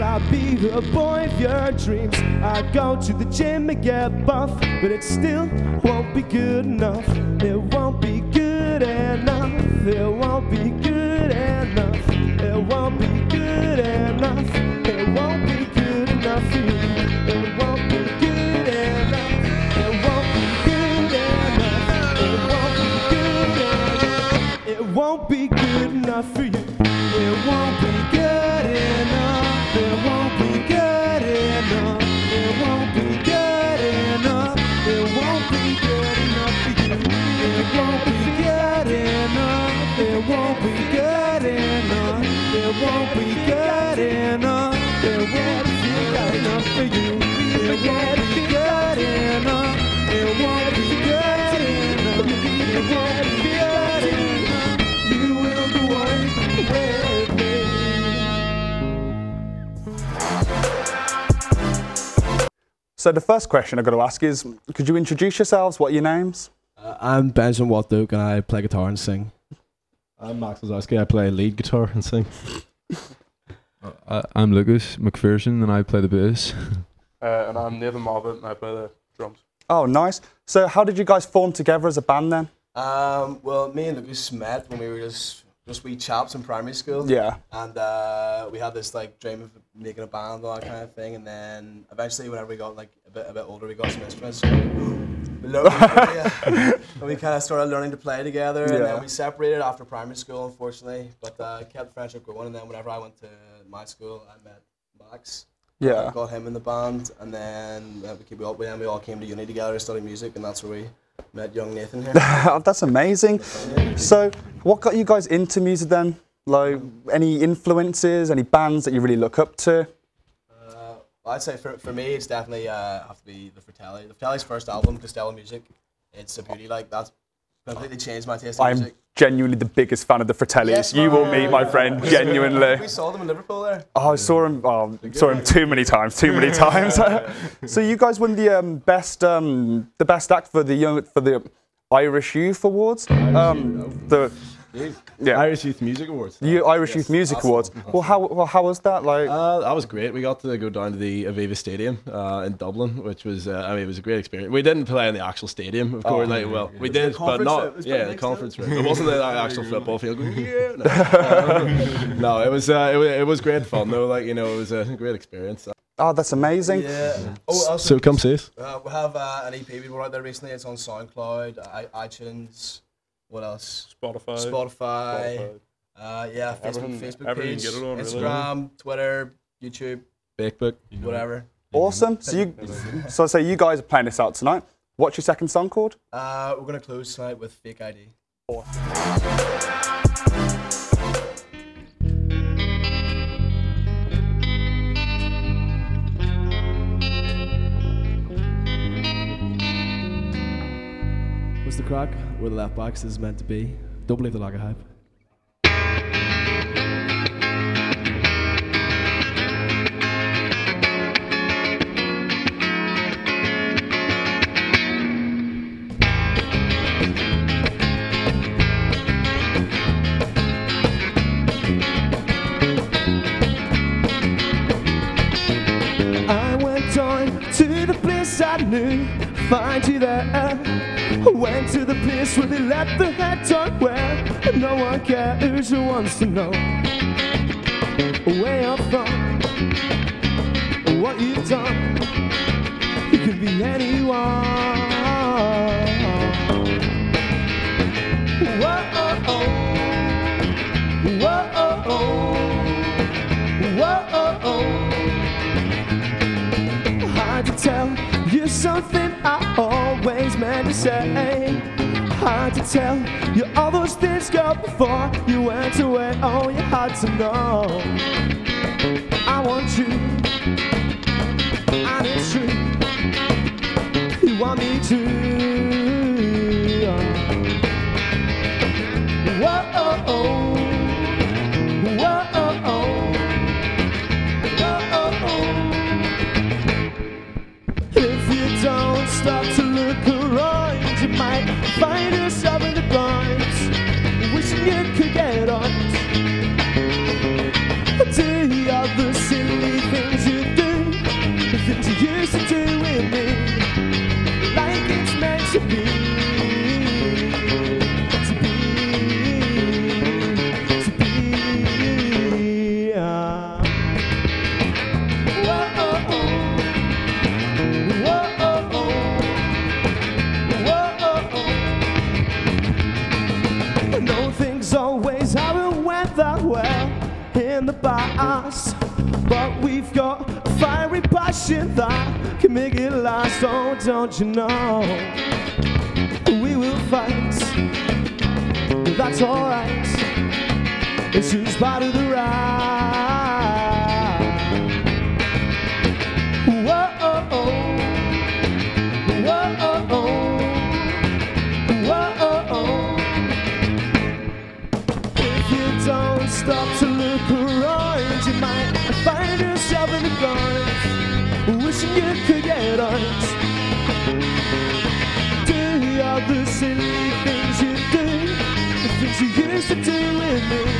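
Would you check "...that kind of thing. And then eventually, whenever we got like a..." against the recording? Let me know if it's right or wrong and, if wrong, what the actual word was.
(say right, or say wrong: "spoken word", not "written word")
right.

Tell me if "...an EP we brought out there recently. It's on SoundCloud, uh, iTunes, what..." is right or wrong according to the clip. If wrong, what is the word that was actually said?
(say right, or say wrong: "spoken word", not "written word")
right.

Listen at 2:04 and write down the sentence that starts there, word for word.
The Fratelli's first album, Costello Music.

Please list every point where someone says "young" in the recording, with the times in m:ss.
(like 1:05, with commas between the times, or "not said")
1:51, 2:20.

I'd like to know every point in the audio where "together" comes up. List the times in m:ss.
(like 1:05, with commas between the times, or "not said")
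1:21, 1:38, 1:49.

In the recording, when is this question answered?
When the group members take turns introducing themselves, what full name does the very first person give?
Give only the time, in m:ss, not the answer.
1:07.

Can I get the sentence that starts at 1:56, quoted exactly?
Like, any influences, any bands that you really look up to?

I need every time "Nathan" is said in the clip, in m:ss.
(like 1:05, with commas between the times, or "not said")
1:17, 1:51.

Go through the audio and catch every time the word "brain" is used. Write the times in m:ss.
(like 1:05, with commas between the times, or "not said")
not said.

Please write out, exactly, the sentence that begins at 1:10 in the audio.
I play lead guitar and sing.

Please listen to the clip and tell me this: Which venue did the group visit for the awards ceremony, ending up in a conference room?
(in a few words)
Aviva Stadium.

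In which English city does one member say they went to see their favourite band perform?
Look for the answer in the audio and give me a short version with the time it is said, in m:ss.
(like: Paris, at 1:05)
Liverpool, at 2:13.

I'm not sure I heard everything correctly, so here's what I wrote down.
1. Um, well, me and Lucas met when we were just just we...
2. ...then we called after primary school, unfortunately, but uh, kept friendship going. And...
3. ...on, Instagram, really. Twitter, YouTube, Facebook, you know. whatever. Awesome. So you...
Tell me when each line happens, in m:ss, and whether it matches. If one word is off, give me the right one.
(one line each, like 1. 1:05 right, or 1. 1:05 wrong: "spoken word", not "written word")
1. 1:22 right
2. 1:38 wrong: "separated", not "called"
3. 2:57 right.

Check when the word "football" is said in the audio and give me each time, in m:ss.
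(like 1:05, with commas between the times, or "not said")
2:39.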